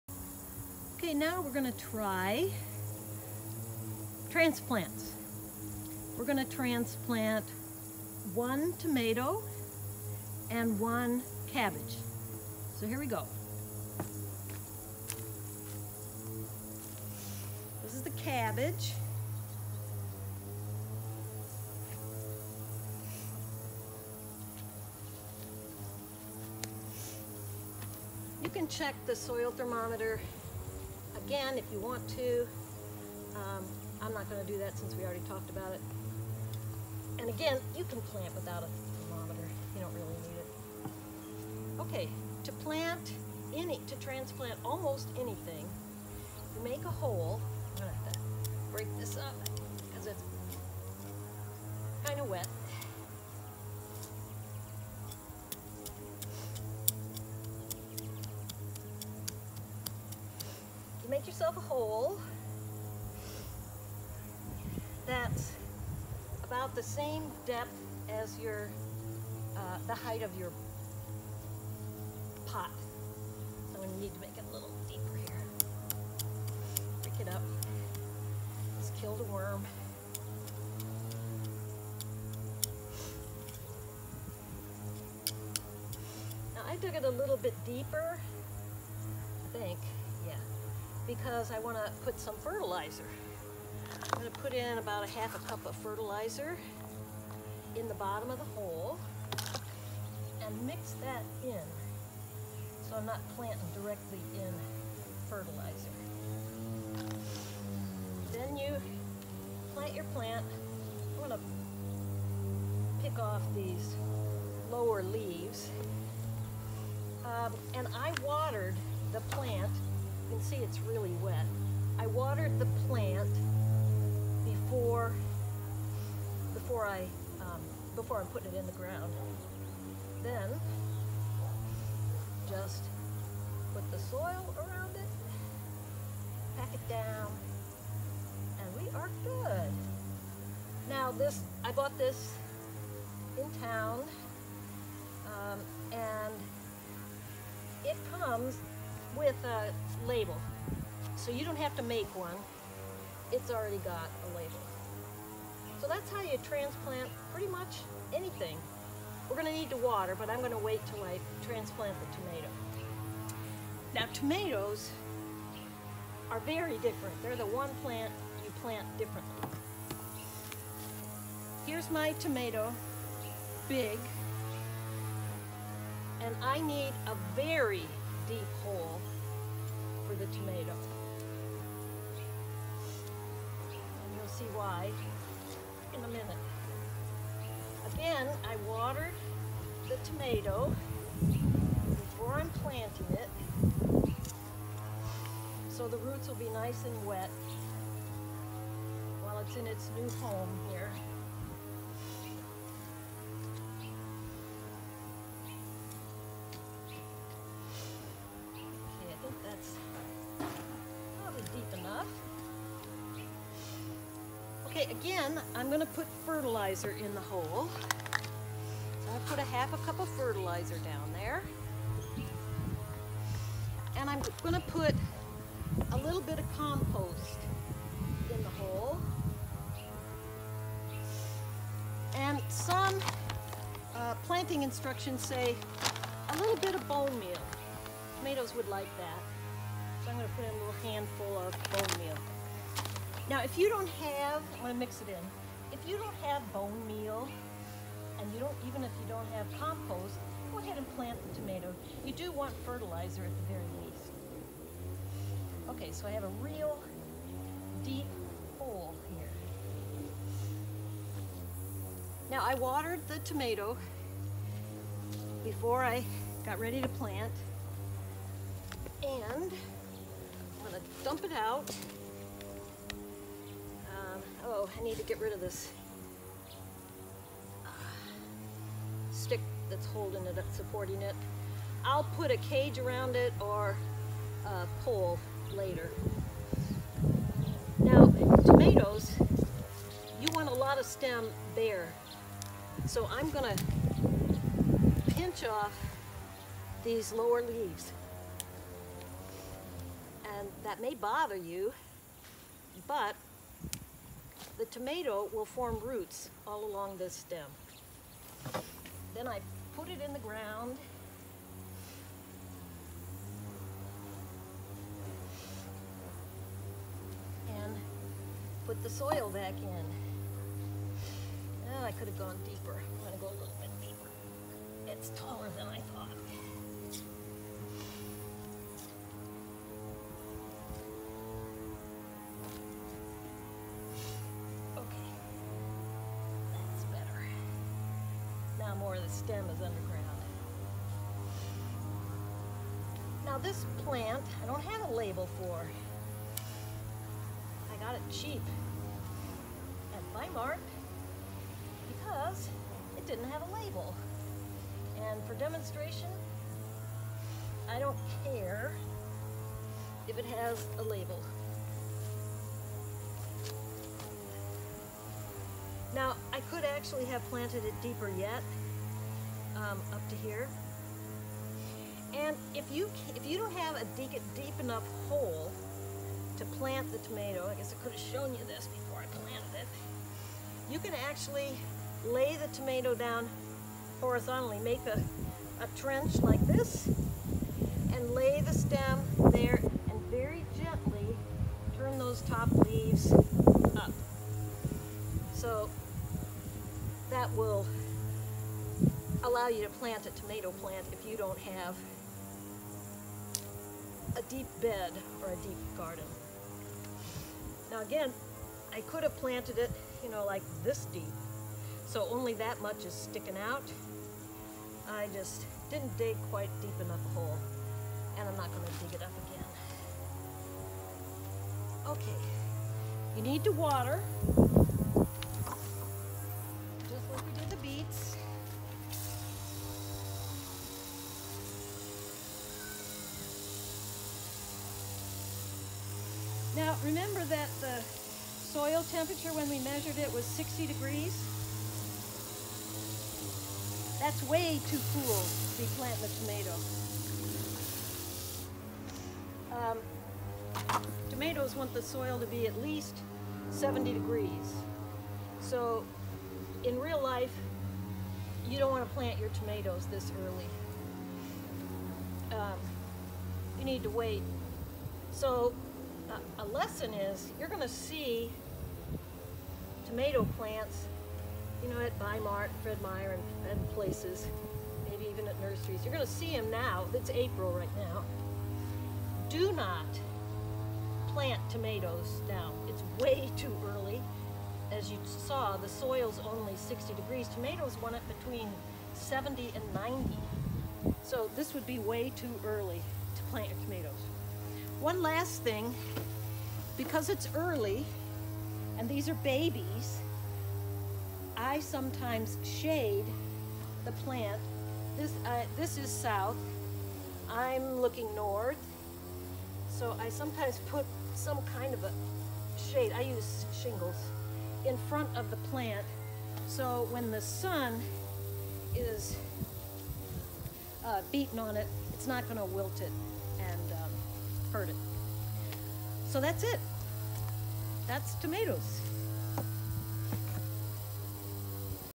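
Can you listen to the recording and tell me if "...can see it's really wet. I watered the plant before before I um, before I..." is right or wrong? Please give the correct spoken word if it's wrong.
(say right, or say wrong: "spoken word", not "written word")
right.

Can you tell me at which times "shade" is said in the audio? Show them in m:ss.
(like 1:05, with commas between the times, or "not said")
8:22, 8:32.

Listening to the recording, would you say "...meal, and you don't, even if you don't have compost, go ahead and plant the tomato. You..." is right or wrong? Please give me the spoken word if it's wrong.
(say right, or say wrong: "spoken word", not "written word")
right.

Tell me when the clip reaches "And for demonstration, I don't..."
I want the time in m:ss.
5:55.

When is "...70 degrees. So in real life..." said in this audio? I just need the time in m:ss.
7:33.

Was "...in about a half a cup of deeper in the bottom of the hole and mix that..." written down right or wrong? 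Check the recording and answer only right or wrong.
wrong.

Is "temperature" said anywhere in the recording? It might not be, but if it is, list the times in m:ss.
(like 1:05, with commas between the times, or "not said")
7:18.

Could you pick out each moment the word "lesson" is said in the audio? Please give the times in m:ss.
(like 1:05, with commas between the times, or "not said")
7:46.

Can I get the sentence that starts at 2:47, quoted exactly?
They're the one plant you plant differently.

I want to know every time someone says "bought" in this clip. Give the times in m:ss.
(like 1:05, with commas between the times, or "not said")
2:21.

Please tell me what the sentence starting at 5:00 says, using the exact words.
And that may bother you, but the tomato will form roots all along this stem.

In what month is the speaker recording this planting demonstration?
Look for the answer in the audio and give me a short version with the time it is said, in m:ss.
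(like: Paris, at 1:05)
April, at 7:57.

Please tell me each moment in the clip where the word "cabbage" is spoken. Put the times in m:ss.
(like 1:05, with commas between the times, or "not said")
0:11, 0:18.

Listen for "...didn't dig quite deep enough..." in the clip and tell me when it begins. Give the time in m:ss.
6:55.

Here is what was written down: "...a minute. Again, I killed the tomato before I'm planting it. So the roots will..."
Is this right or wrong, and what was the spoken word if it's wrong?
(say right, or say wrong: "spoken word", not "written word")
wrong: "watered", not "killed".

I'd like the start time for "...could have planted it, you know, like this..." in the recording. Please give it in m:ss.
6:48.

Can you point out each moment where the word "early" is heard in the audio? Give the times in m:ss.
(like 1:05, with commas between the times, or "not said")
7:40, 8:03, 8:12, 8:17.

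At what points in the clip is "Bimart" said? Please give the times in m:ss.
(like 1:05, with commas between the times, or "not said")
5:50, 7:51.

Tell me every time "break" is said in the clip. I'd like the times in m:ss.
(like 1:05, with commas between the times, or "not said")
0:48, 1:17.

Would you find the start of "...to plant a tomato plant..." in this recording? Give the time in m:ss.
6:39.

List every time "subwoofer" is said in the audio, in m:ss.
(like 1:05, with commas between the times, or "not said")
not said.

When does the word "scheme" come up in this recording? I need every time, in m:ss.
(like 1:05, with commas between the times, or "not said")
not said.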